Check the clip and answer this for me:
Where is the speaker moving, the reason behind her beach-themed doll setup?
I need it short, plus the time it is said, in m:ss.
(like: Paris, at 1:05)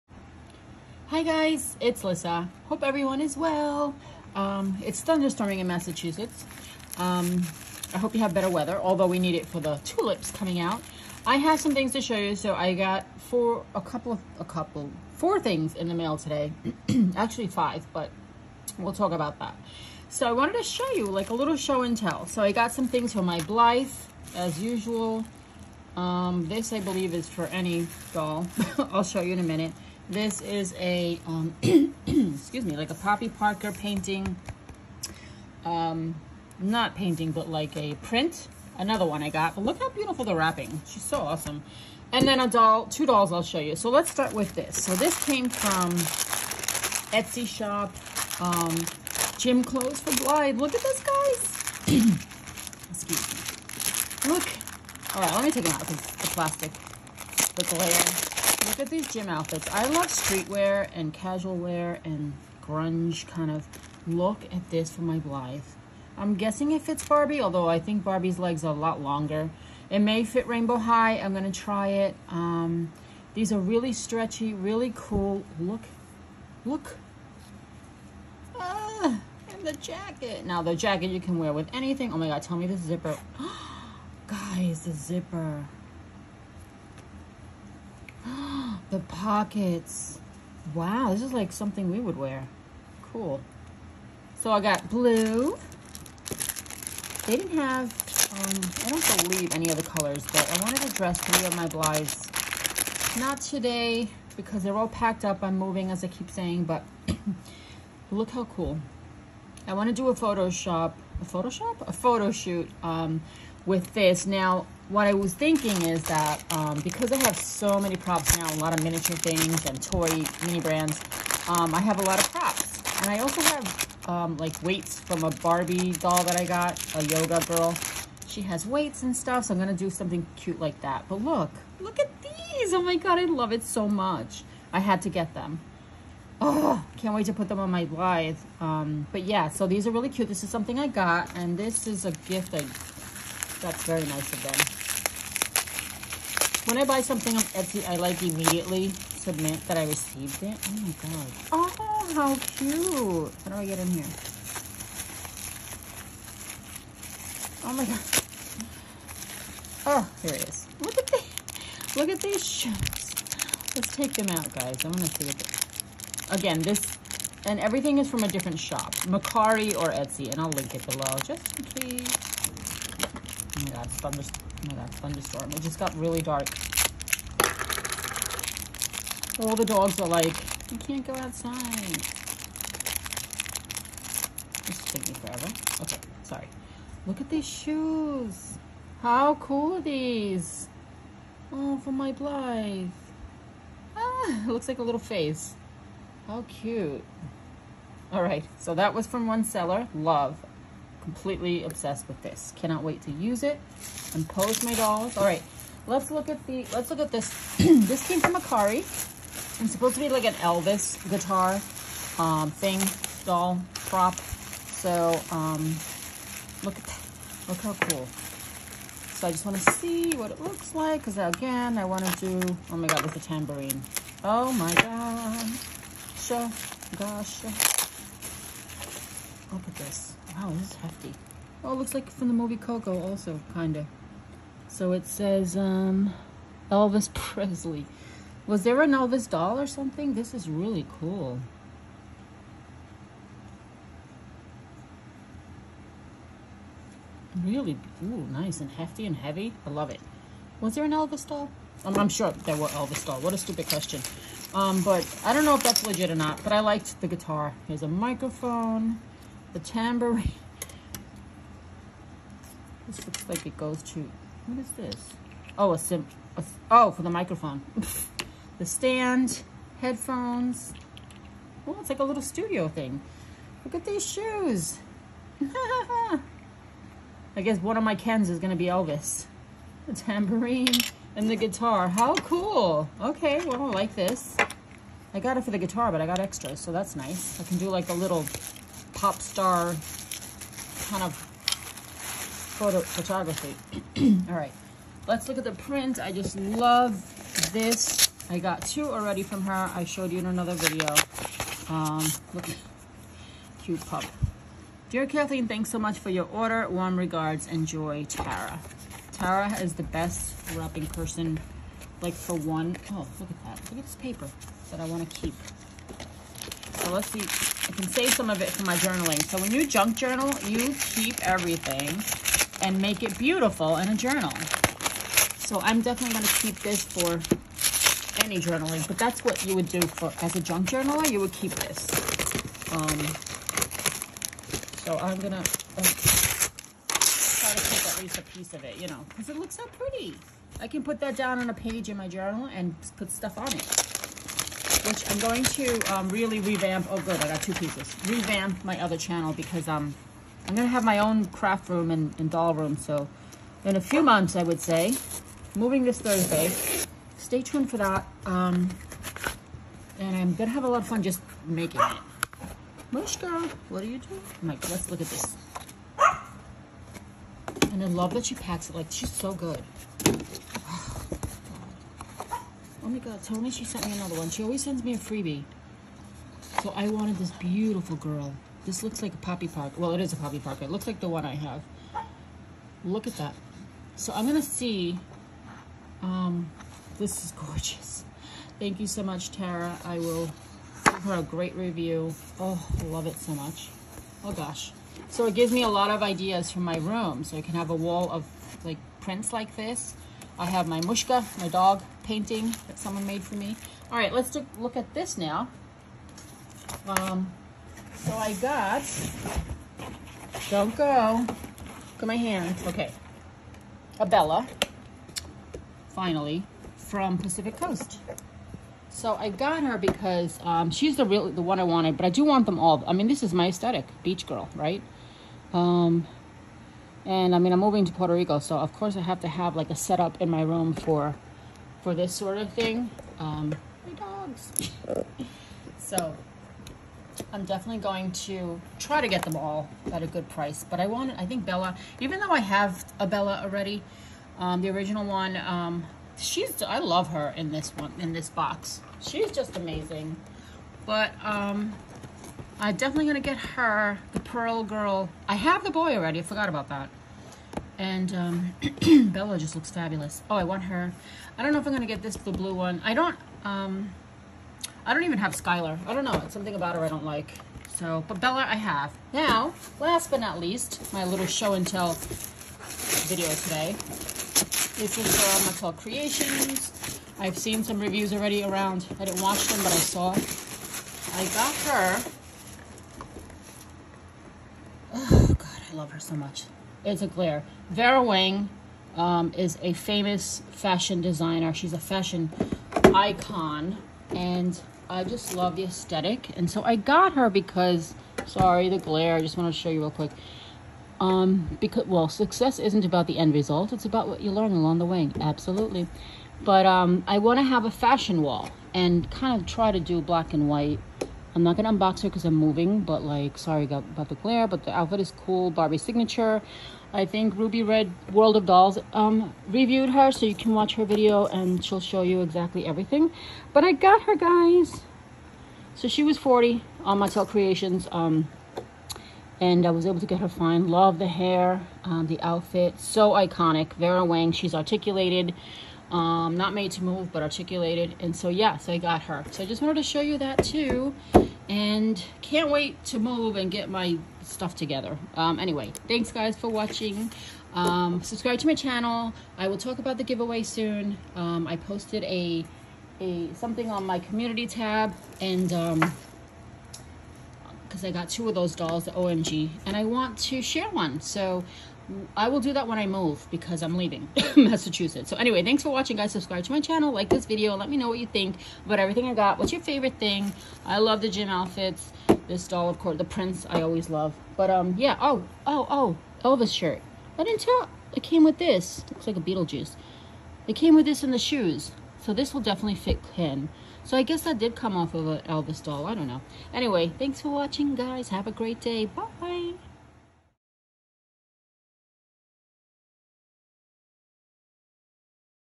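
Puerto Rico, at 7:07.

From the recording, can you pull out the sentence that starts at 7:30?
But, um, I'm definitely going to get her the Pearl Girl.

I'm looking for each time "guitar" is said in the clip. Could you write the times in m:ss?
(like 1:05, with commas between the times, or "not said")
3:31, 4:17, 4:41, 4:45.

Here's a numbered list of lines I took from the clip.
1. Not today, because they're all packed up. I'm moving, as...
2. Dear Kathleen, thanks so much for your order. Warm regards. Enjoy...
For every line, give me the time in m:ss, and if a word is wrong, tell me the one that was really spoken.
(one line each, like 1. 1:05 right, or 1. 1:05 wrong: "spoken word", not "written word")
1. 1:43 right
2. 5:04 right.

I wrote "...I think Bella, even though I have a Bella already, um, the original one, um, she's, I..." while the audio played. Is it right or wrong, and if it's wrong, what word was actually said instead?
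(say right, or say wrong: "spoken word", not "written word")
right.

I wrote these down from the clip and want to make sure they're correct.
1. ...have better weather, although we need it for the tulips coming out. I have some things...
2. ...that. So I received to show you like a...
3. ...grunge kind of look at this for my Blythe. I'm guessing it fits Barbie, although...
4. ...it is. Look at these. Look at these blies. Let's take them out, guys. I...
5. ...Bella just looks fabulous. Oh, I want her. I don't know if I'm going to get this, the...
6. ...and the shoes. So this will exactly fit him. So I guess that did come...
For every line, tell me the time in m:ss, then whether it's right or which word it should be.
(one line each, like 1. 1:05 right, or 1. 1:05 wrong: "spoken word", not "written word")
1. 0:08 right
2. 0:19 wrong: "wanted", not "received"
3. 1:02 right
4. 2:40 wrong: "shoes", not "blies"
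5. 7:39 right
6. 9:41 wrong: "definitely", not "exactly".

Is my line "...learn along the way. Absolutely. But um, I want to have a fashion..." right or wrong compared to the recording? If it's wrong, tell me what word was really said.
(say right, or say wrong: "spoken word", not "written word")
right.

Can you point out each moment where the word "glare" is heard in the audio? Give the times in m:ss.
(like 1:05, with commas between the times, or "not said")
0:57, 8:07, 8:18, 8:34.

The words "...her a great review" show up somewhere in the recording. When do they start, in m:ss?
6:31.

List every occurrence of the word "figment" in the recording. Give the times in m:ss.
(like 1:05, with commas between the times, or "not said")
not said.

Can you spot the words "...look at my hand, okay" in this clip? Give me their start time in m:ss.
6:51.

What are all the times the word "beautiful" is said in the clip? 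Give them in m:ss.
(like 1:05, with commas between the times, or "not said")
0:39, 5:23, 6:17.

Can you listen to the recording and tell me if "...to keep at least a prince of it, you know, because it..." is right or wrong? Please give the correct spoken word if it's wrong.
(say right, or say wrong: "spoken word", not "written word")
wrong: "piece", not "prince".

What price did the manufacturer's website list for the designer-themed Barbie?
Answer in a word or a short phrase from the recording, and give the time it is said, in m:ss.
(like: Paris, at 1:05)
40, at 8:46.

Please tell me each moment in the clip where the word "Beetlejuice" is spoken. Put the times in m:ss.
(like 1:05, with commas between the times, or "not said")
9:39.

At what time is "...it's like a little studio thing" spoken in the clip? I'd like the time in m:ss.
4:31.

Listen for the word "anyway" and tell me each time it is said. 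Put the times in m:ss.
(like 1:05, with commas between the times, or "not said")
9:05, 9:25, 9:46.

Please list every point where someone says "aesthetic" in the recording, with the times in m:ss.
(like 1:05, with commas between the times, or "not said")
7:03, 8:15.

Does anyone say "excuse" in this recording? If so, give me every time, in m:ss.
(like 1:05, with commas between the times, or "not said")
0:31, 0:52.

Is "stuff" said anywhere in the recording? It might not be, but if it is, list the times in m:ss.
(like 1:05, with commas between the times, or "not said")
2:09, 5:43, 9:04.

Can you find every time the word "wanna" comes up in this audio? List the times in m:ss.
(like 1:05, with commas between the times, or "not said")
not said.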